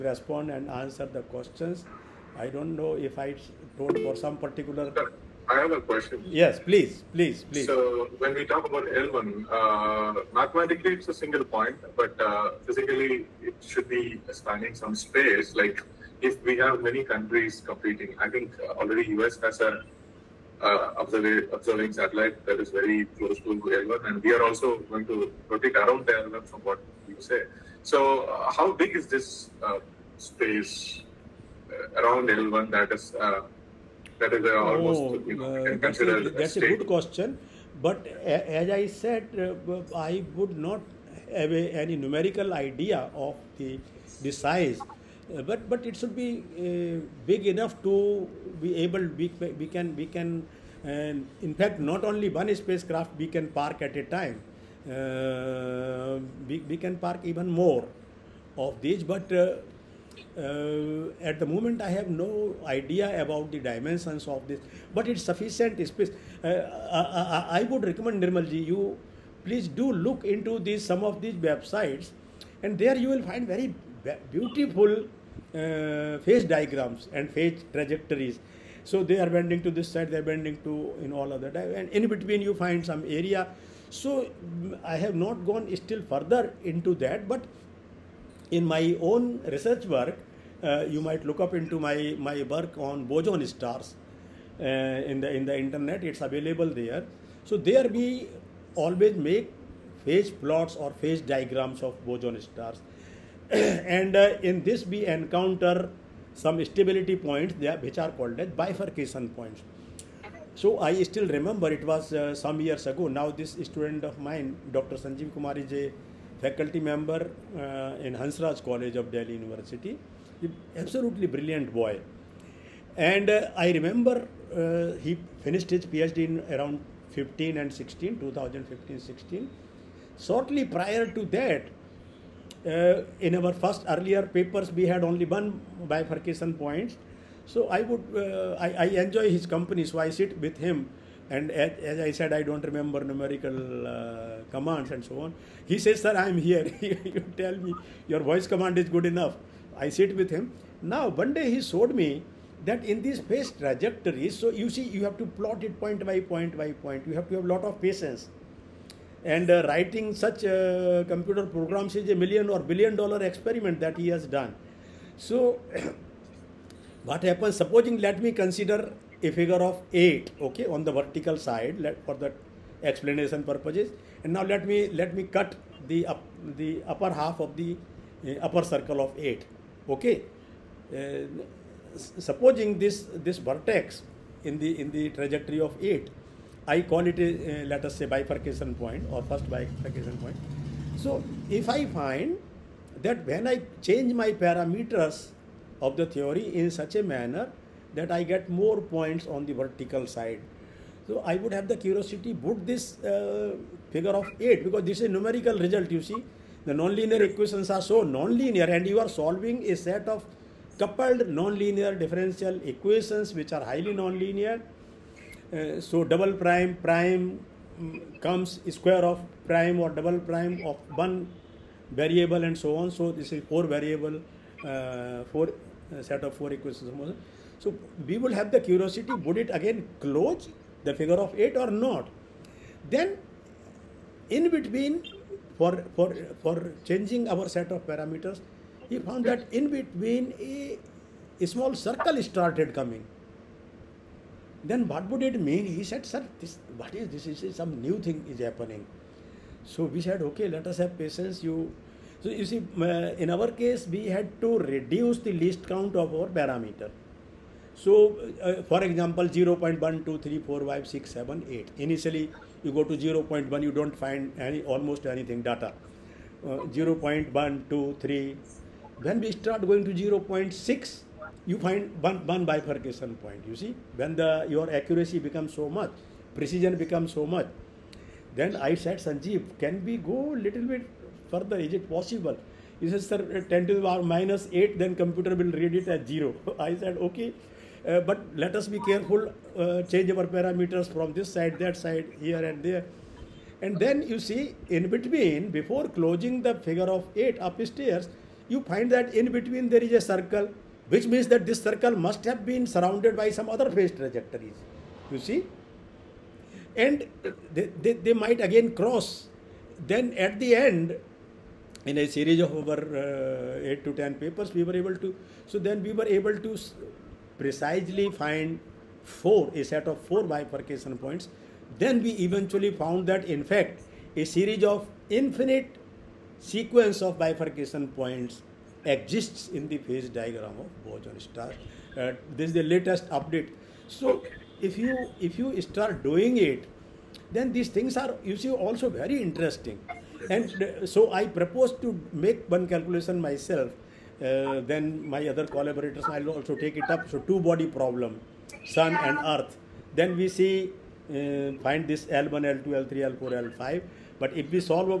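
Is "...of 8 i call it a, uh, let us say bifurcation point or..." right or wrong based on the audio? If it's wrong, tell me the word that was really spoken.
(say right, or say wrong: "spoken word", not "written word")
right.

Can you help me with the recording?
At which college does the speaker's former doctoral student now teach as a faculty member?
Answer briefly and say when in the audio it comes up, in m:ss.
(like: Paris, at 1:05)
Hansraj College, at 1:58.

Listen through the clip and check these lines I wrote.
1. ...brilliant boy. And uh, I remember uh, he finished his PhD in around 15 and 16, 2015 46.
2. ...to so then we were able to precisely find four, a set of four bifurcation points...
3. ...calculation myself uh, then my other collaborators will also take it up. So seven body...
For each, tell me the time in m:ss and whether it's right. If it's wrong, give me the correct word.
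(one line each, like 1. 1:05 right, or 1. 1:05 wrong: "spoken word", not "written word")
1. 2:01 wrong: "16", not "46"
2. 5:14 right
3. 5:42 wrong: "two", not "seven".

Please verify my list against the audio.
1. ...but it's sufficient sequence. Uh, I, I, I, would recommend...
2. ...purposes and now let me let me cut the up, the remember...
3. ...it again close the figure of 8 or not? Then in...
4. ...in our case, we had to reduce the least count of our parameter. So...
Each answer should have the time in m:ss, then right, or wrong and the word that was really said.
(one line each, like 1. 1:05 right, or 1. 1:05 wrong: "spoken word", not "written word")
1. 1:04 wrong: "space", not "sequence"
2. 2:53 wrong: "upper", not "remember"
3. 3:49 right
4. 4:12 right.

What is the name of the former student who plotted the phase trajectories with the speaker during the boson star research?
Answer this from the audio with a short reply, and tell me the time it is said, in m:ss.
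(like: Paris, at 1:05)
Sanjeev Kumar, at 1:54.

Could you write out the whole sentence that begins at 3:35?
Uh, so double prime, prime mm, comes square of prime or double prime of one variable and so on.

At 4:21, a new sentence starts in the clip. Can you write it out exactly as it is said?
Initially, you go to 0.1, you don't find any almost anything data.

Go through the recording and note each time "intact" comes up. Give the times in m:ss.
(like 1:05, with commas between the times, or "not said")
not said.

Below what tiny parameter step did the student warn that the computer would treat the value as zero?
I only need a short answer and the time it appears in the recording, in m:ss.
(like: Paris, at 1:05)
10^-8, at 4:43.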